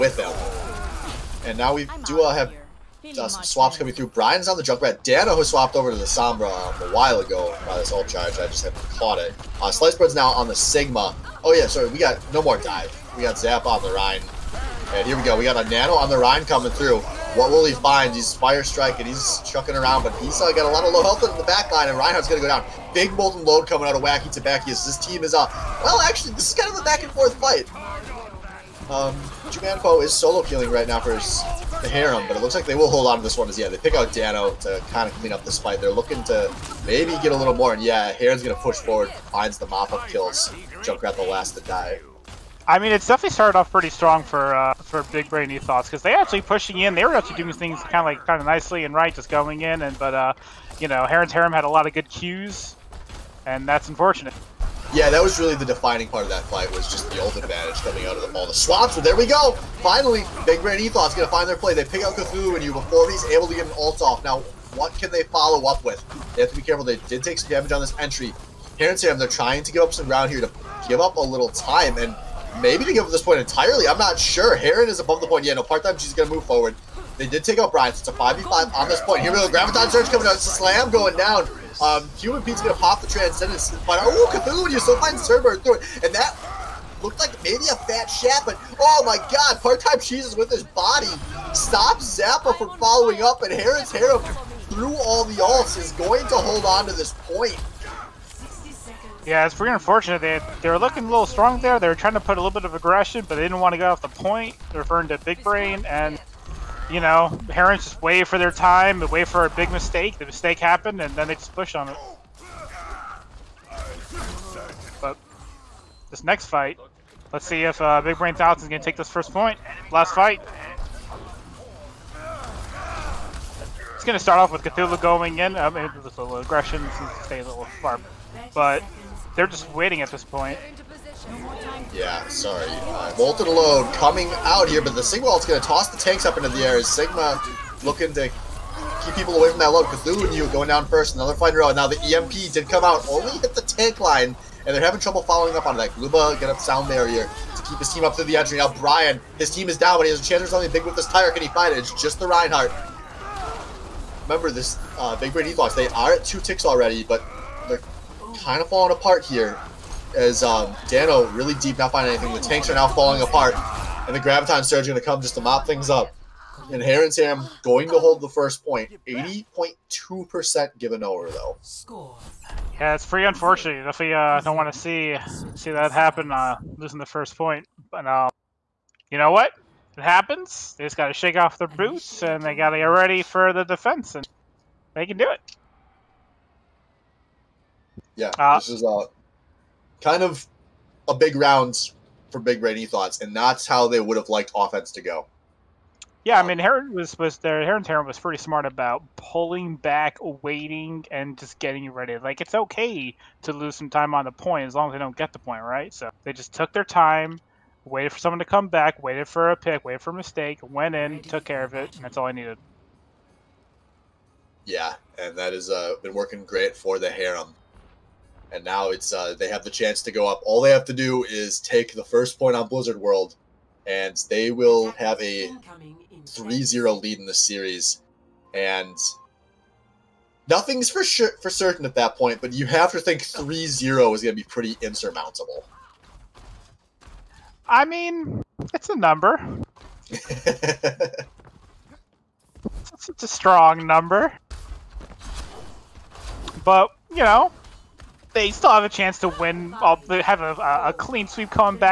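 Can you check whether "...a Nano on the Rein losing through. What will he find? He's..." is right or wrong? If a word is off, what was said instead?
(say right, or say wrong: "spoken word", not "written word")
wrong: "coming", not "losing".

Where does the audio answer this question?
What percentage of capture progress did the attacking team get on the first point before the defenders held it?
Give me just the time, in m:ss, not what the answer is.
2:49.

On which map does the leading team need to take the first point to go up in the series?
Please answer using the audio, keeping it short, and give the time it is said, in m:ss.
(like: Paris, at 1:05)
Blizzard World, at 3:42.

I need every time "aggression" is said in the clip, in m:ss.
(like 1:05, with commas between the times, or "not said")
1:42, 2:06.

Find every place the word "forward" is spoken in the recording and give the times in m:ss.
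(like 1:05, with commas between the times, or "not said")
0:38, 1:16.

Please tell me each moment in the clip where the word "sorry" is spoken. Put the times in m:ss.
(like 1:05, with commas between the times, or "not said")
0:11, 2:12.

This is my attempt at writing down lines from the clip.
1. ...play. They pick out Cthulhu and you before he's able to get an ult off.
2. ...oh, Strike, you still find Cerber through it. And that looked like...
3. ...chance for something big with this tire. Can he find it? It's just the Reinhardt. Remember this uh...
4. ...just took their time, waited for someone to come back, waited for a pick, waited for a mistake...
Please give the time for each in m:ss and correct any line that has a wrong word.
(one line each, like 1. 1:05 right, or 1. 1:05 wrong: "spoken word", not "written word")
1. 1:01 right
2. 1:24 wrong: "Cthulhu", not "Strike"
3. 2:30 right
4. 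3:26 right.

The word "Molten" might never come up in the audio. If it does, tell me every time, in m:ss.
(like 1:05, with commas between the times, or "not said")
0:23, 2:13.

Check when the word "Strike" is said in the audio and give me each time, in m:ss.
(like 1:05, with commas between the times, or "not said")
0:18.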